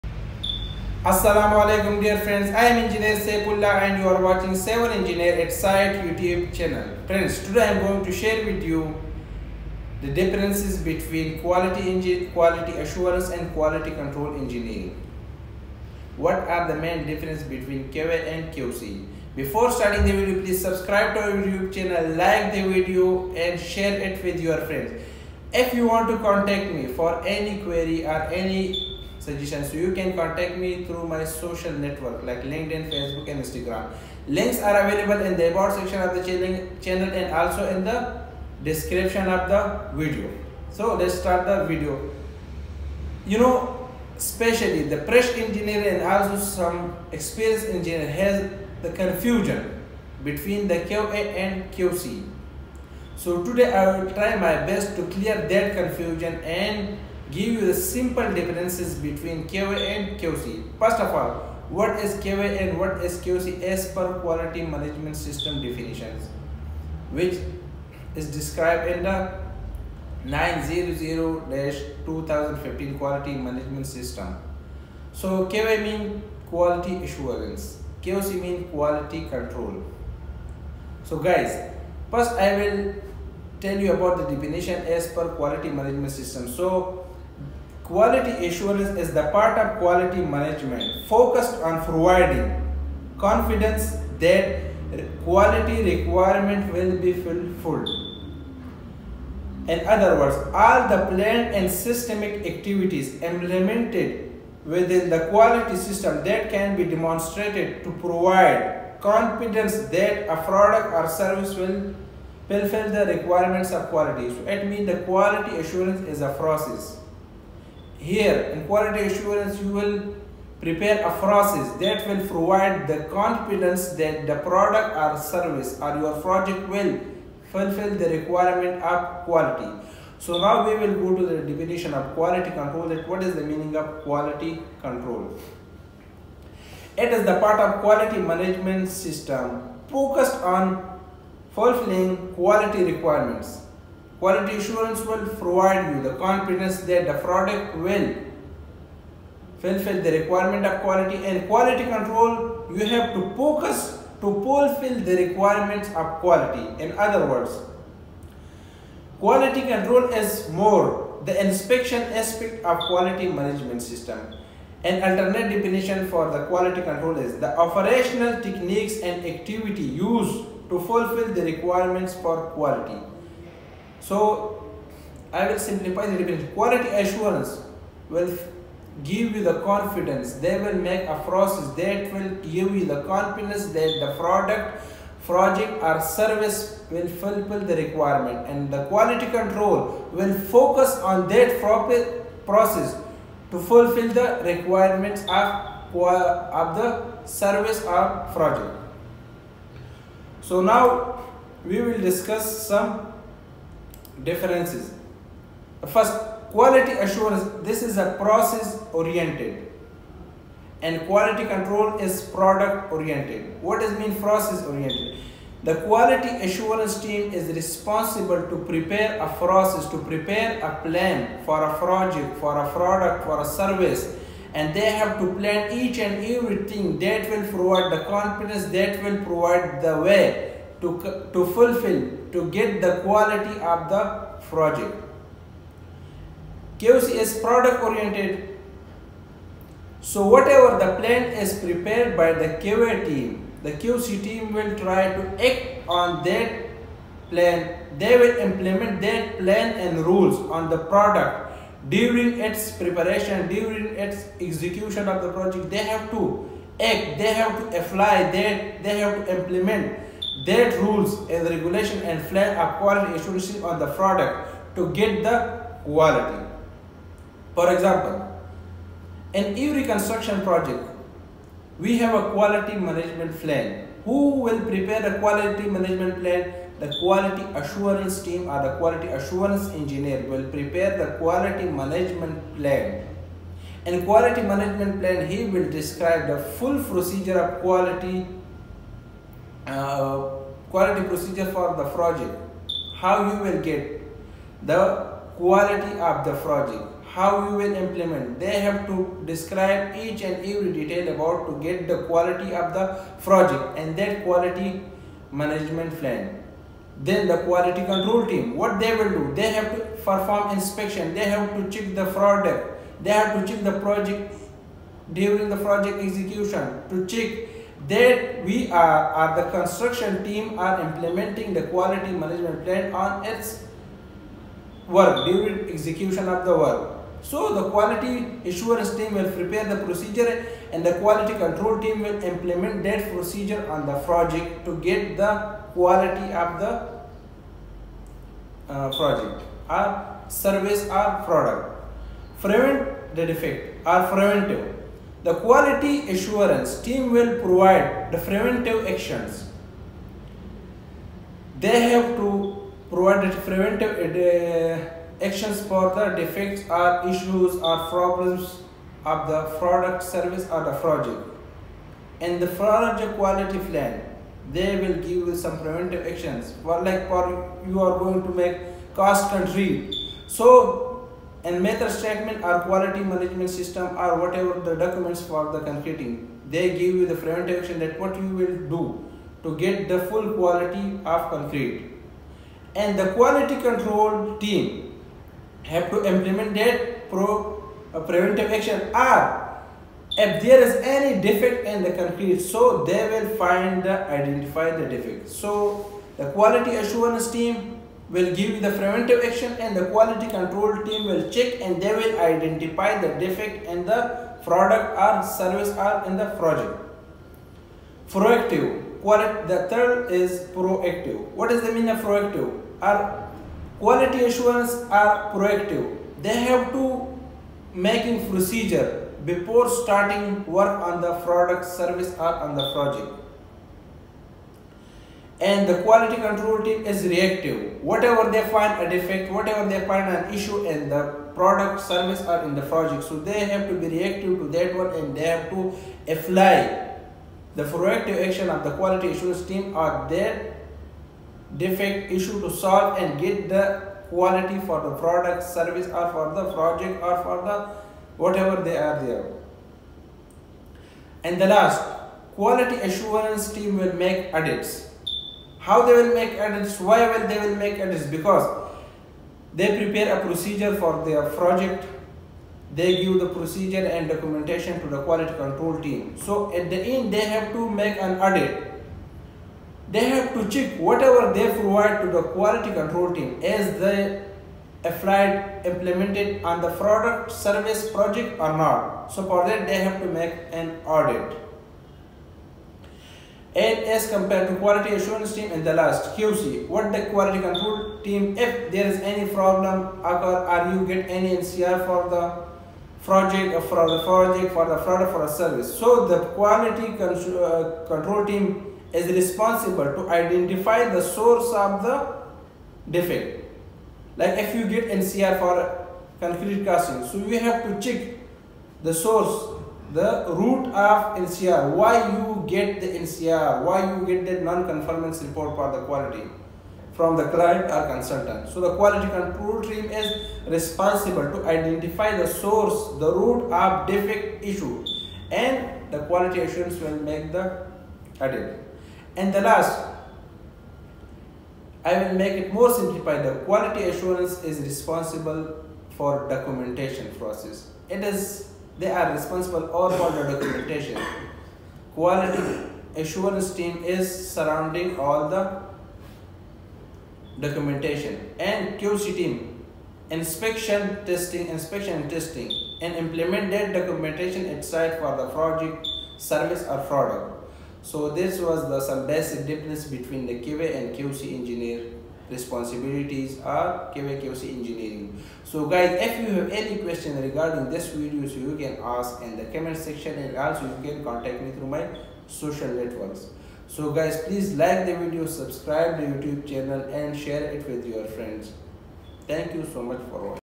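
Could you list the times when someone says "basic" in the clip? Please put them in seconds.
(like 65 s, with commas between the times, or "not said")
559 s.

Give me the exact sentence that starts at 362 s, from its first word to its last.
And the project quality plan, they will give you some preventive actions.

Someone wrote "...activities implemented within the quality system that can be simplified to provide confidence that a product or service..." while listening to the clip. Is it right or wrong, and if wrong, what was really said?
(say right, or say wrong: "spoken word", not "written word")
wrong: "demonstrated", not "simplified".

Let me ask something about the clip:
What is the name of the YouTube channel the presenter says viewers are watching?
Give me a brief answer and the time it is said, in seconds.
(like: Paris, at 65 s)
Civil Engineer at Site, at 4 s.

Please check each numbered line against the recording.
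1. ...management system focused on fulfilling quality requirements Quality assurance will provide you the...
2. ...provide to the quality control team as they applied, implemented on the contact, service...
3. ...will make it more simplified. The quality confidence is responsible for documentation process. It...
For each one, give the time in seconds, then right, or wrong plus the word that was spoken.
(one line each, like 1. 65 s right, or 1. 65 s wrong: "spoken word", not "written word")
1. 138 s right
2. 471 s wrong: "product", not "contact"
3. 532 s wrong: "assurance", not "confidence".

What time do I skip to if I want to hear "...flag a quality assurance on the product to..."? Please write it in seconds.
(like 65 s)
262 s.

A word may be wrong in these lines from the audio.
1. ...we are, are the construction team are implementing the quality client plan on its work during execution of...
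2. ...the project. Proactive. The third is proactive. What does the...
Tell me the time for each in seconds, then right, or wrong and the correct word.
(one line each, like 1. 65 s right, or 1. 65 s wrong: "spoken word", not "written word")
1. 318 s wrong: "management", not "client"
2. 406 s right.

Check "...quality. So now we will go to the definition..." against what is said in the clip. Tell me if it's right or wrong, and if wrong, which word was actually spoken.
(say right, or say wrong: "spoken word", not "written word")
right.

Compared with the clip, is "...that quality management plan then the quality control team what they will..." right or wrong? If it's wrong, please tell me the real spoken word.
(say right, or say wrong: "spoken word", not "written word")
right.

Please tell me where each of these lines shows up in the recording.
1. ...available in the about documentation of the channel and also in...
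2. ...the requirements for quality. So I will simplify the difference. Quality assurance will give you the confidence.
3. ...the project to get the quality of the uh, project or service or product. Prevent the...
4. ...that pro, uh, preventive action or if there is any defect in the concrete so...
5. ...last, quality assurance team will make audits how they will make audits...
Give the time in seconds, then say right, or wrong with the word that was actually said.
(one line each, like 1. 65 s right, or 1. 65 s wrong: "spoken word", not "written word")
1. 34 s wrong: "section", not "documentation"
2. 171 s right
3. 333 s right
4. 386 s right
5. 451 s right.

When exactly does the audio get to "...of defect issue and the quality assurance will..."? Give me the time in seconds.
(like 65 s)
523 s.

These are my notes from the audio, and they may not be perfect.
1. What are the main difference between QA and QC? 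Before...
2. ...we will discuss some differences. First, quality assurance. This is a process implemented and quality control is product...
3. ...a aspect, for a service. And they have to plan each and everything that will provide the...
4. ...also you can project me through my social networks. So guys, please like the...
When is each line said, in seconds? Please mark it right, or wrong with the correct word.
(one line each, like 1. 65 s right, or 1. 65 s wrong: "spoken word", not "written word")
1. 16 s right
2. 201 s wrong: "oriented", not "implemented"
3. 222 s wrong: "product", not "aspect"
4. 570 s wrong: "contact", not "project".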